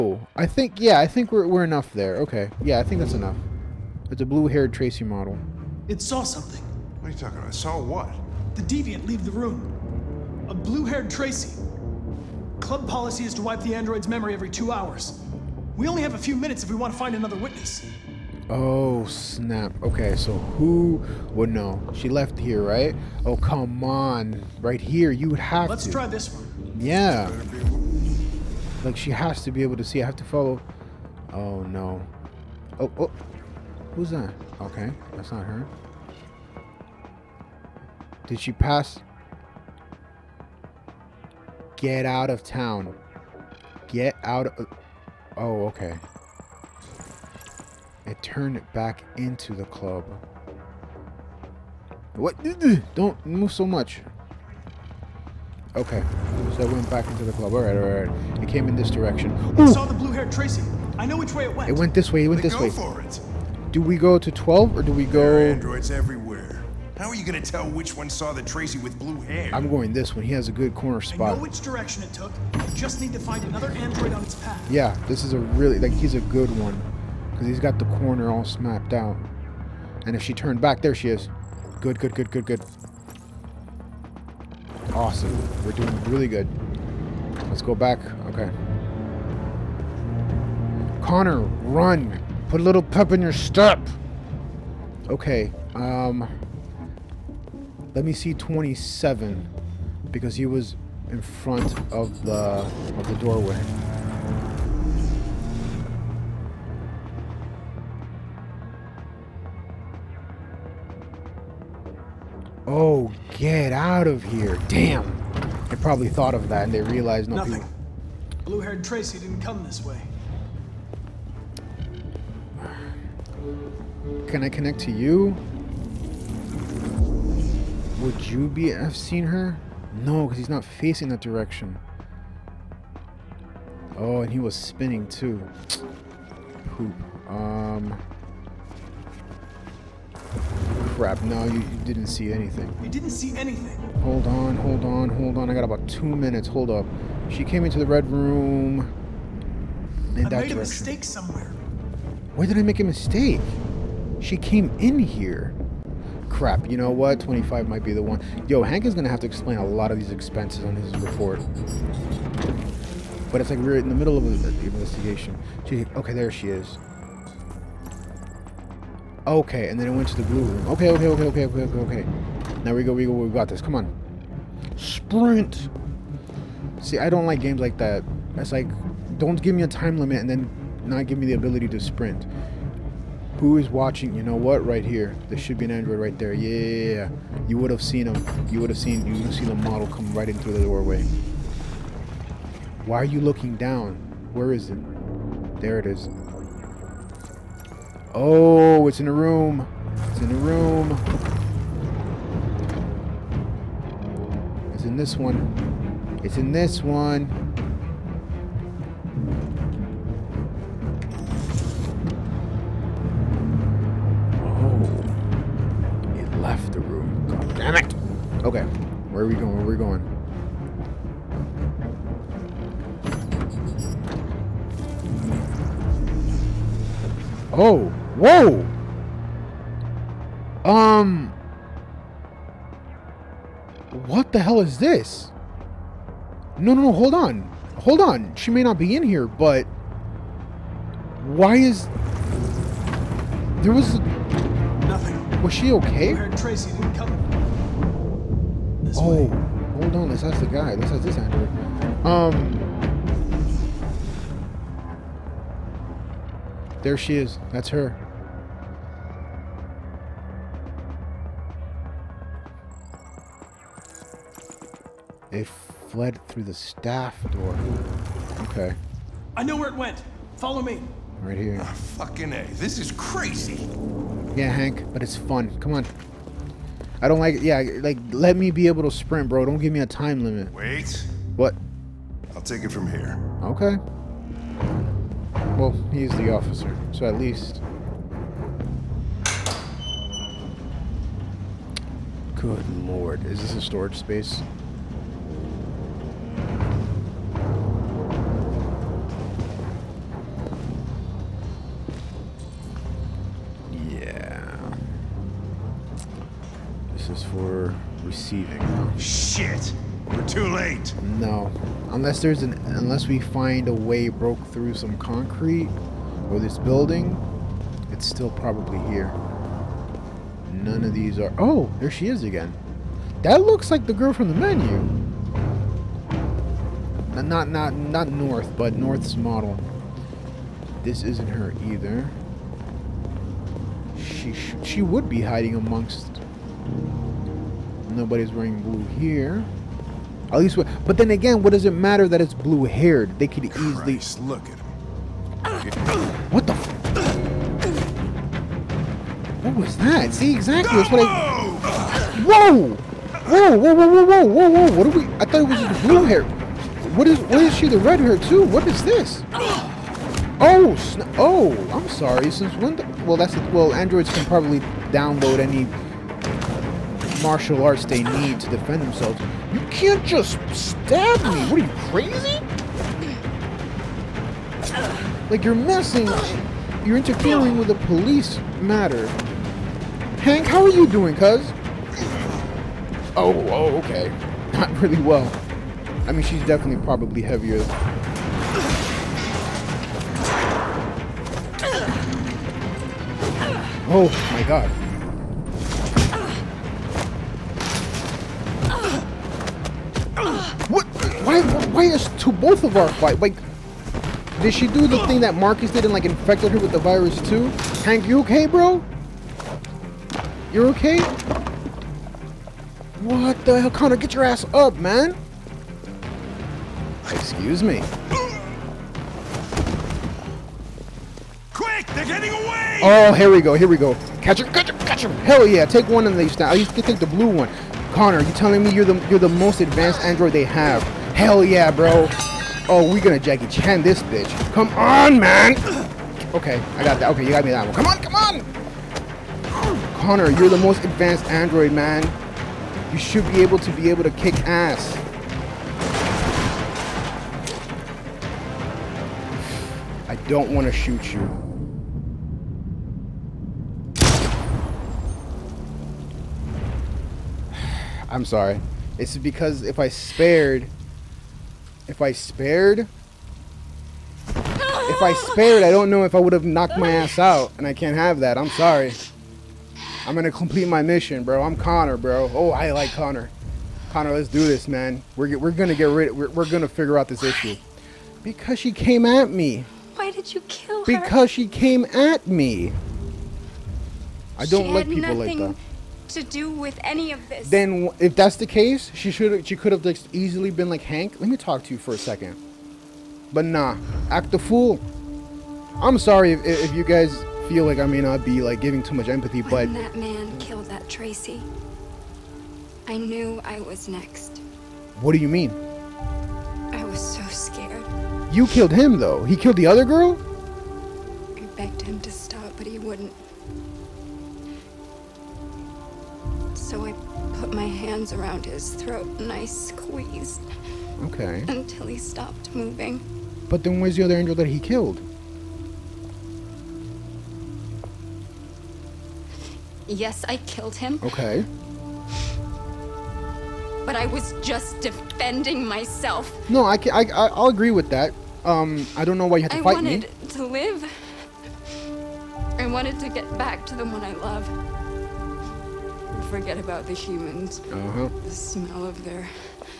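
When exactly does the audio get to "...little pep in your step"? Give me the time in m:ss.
1:32.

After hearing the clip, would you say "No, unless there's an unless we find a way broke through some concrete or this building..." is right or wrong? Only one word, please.
right.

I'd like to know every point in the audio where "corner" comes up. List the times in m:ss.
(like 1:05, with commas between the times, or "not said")
1:10, 1:17.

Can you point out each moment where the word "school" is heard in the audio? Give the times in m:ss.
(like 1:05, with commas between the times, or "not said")
not said.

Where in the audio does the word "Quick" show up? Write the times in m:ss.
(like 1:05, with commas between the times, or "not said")
7:01.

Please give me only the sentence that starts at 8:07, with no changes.
Then, if that's the case, she should she could have just easily been like Hank.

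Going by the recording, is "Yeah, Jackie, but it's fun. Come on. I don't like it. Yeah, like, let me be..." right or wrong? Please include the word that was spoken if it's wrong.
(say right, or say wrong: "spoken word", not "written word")
wrong: "Hank", not "Jackie".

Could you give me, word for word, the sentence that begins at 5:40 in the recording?
At least, but then again, what does it matter that it's blue-haired?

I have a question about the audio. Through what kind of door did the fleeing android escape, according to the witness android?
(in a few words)
staff door.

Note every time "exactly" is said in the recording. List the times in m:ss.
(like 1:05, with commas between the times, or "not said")
5:50.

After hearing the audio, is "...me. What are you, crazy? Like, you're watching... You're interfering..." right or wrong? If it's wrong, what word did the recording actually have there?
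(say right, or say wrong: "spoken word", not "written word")
wrong: "messing", not "watching".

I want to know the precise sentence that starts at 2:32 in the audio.
Where did I make a mistake?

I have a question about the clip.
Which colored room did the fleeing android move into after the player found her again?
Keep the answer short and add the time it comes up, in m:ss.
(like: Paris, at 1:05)
the blue room, at 2:50.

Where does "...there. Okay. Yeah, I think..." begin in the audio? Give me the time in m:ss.
0:01.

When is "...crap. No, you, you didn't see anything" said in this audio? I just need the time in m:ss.
2:20.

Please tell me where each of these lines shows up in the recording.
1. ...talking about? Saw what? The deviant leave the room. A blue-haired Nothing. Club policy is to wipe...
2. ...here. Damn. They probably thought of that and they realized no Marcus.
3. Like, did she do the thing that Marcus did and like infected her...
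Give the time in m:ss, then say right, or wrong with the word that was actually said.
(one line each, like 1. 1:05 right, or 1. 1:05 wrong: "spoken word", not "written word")
1. 0:07 wrong: "Tracy", not "Nothing"
2. 1:54 wrong: "Nothing", not "Marcus"
3. 6:43 right.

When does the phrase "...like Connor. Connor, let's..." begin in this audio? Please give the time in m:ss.
7:52.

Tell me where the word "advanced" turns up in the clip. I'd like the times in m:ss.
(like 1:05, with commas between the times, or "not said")
7:09, 7:20.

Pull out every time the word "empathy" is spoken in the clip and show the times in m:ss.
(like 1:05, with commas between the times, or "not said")
8:19.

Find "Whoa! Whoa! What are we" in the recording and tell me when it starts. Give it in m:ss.
5:54.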